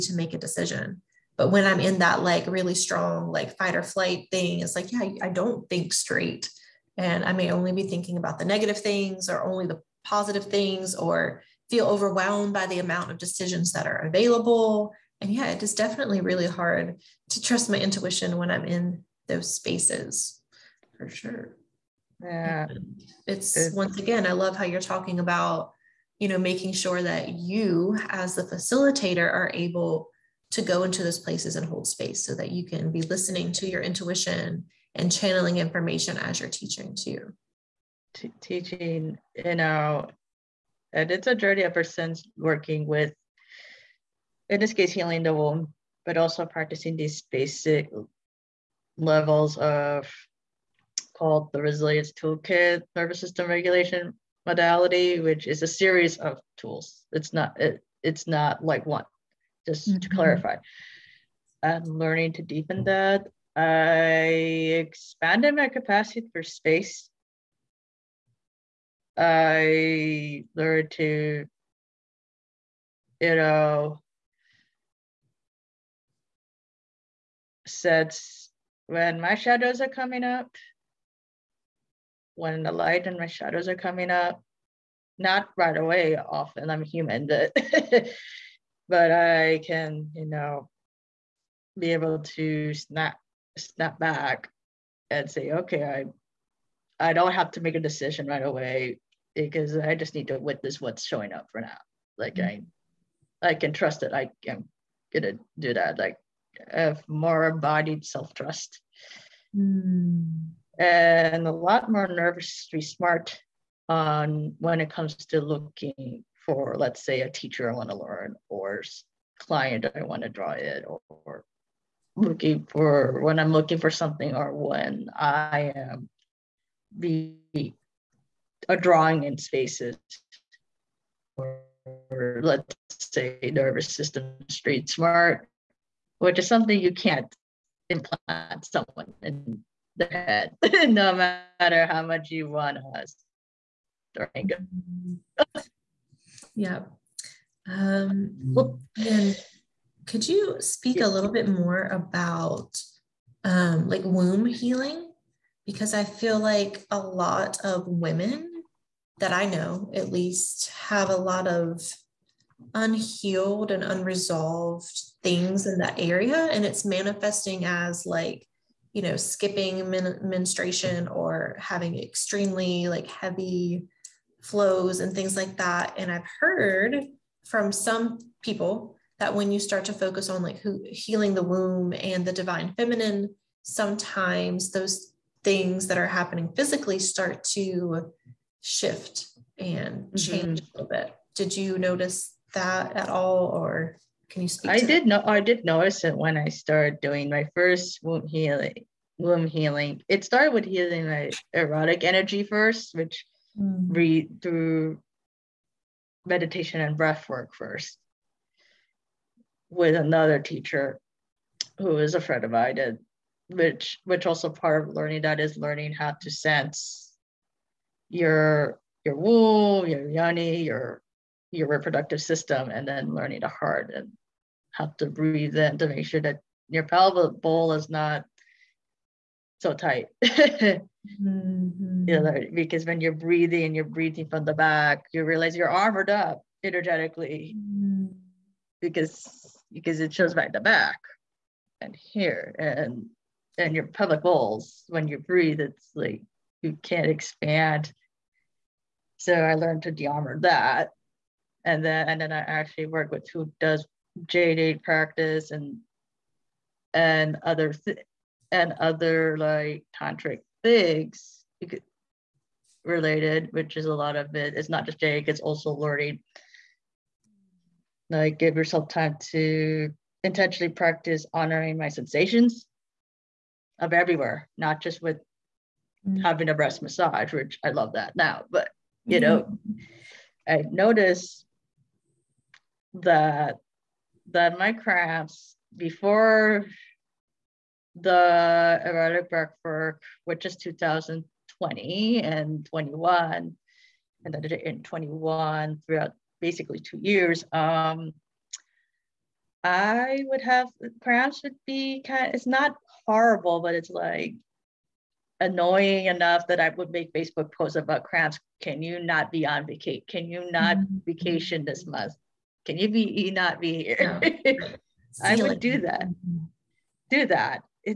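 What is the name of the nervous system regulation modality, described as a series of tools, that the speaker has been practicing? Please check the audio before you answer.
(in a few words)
Resilience Toolkit.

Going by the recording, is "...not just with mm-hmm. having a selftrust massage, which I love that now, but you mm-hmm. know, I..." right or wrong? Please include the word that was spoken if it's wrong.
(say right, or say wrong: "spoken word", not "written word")
wrong: "breast", not "selftrust".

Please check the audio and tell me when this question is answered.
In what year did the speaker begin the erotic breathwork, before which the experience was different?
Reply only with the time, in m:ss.
4:50.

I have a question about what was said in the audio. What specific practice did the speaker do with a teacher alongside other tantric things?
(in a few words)
jade egg practice.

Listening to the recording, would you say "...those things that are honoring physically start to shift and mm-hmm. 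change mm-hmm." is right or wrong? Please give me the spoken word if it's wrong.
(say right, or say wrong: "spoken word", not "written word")
wrong: "happening", not "honoring".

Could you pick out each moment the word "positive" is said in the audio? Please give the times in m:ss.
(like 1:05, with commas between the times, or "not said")
0:10.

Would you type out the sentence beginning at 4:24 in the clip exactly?
It's not just jade, it's also learning.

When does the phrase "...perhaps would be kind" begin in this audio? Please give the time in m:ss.
5:01.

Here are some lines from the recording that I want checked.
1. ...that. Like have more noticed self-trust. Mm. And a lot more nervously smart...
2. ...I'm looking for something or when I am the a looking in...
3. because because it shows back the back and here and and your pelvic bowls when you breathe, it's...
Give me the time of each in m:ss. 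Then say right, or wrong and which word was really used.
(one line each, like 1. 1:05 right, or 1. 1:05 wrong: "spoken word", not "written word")
1. 1:45 wrong: "embodied", not "noticed"
2. 2:03 wrong: "drawing", not "looking"
3. 3:58 right.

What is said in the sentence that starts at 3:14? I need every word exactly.
I did know I did notice it when I started doing my first womb healing womb healing.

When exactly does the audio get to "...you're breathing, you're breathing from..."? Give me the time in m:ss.
3:53.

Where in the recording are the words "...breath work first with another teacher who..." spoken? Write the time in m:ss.
3:26.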